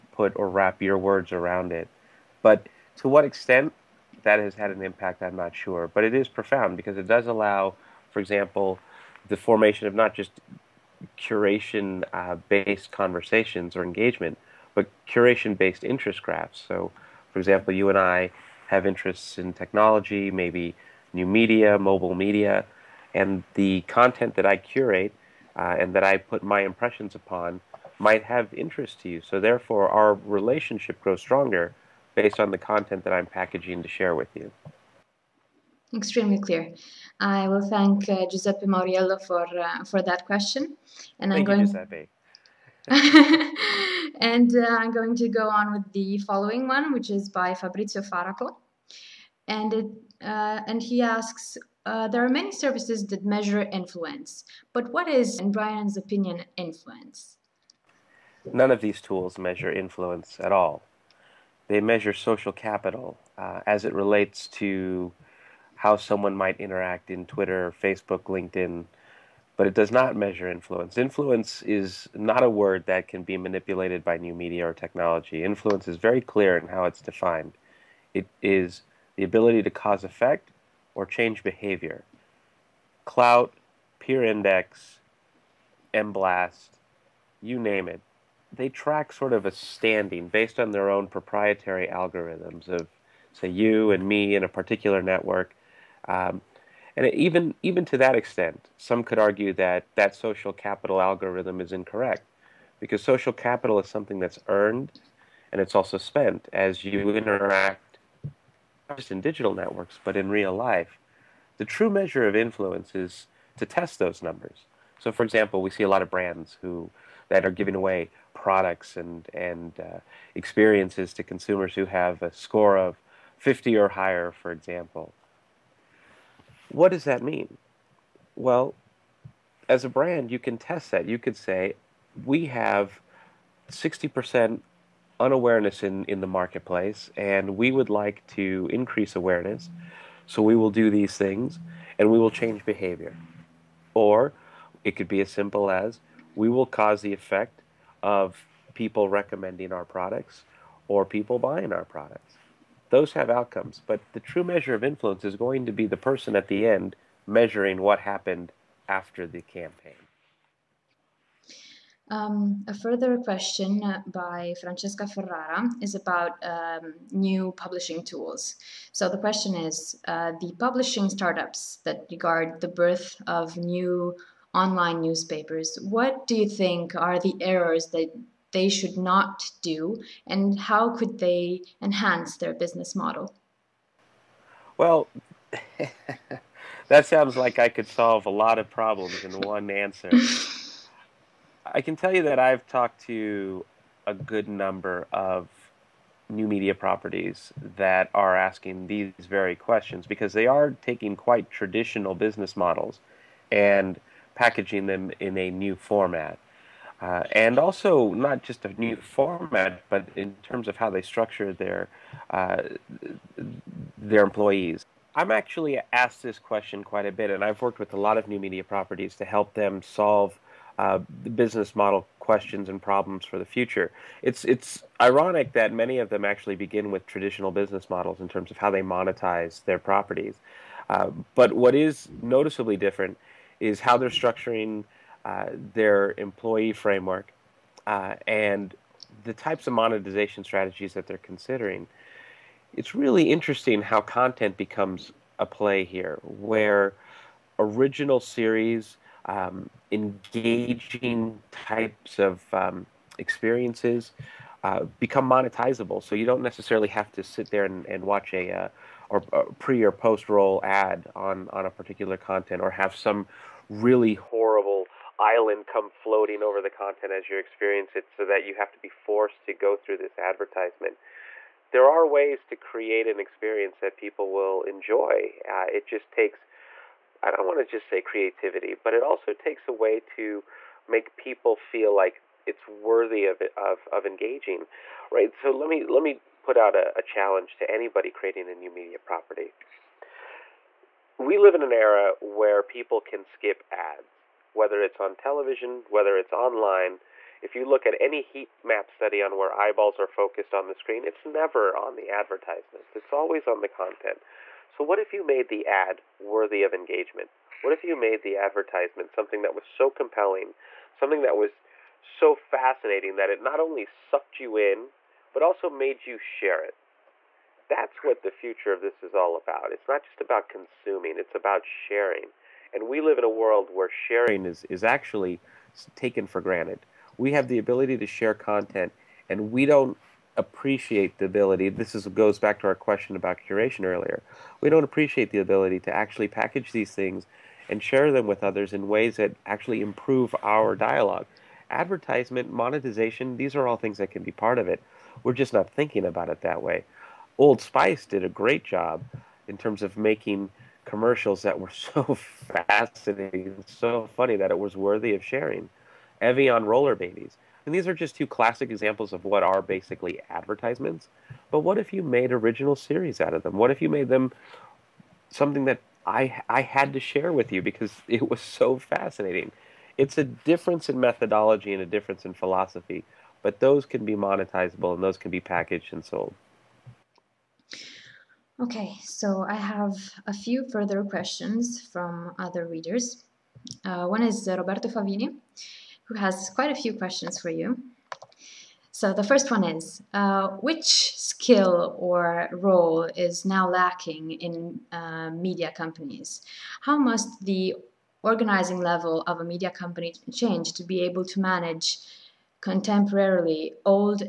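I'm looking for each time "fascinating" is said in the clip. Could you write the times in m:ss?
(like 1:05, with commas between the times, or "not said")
5:12, 5:52, 6:08.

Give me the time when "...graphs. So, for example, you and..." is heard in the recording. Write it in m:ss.
0:16.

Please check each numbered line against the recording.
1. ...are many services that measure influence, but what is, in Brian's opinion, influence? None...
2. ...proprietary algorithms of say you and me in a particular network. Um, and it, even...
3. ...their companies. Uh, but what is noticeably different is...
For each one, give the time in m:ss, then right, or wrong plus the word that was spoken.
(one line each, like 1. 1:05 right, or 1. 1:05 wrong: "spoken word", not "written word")
1. 0:52 right
2. 1:31 right
3. 3:49 wrong: "properties", not "companies".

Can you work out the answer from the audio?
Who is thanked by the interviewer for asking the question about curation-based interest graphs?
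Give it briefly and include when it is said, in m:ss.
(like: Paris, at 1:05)
Giuseppe Mauriello, at 0:38.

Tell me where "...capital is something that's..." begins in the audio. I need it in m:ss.
1:43.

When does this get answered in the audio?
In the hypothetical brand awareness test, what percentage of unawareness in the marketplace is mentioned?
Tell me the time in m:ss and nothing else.
2:13.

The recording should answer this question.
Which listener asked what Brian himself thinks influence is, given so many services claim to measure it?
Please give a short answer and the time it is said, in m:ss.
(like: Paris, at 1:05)
Fabrizio Faraco, at 0:47.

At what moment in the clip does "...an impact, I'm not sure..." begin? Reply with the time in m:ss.
0:04.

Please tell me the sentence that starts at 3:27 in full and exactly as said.
Uh, and also not just a new format, but in terms of how they structure their uh, their employees.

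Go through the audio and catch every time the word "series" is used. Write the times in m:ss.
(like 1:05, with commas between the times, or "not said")
4:08, 6:02.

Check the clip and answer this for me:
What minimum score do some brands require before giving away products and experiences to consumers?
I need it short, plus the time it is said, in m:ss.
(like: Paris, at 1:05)
50, at 2:03.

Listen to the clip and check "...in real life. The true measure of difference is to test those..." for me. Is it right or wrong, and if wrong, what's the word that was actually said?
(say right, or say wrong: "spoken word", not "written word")
wrong: "influence", not "difference".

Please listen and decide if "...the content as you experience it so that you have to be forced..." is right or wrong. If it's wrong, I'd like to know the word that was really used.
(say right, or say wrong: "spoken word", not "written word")
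right.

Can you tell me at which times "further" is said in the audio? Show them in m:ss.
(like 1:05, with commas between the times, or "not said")
2:42, 6:20.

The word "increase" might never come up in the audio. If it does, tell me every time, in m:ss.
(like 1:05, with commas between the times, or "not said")
2:18.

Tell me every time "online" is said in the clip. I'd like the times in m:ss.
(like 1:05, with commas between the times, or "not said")
2:54, 4:56.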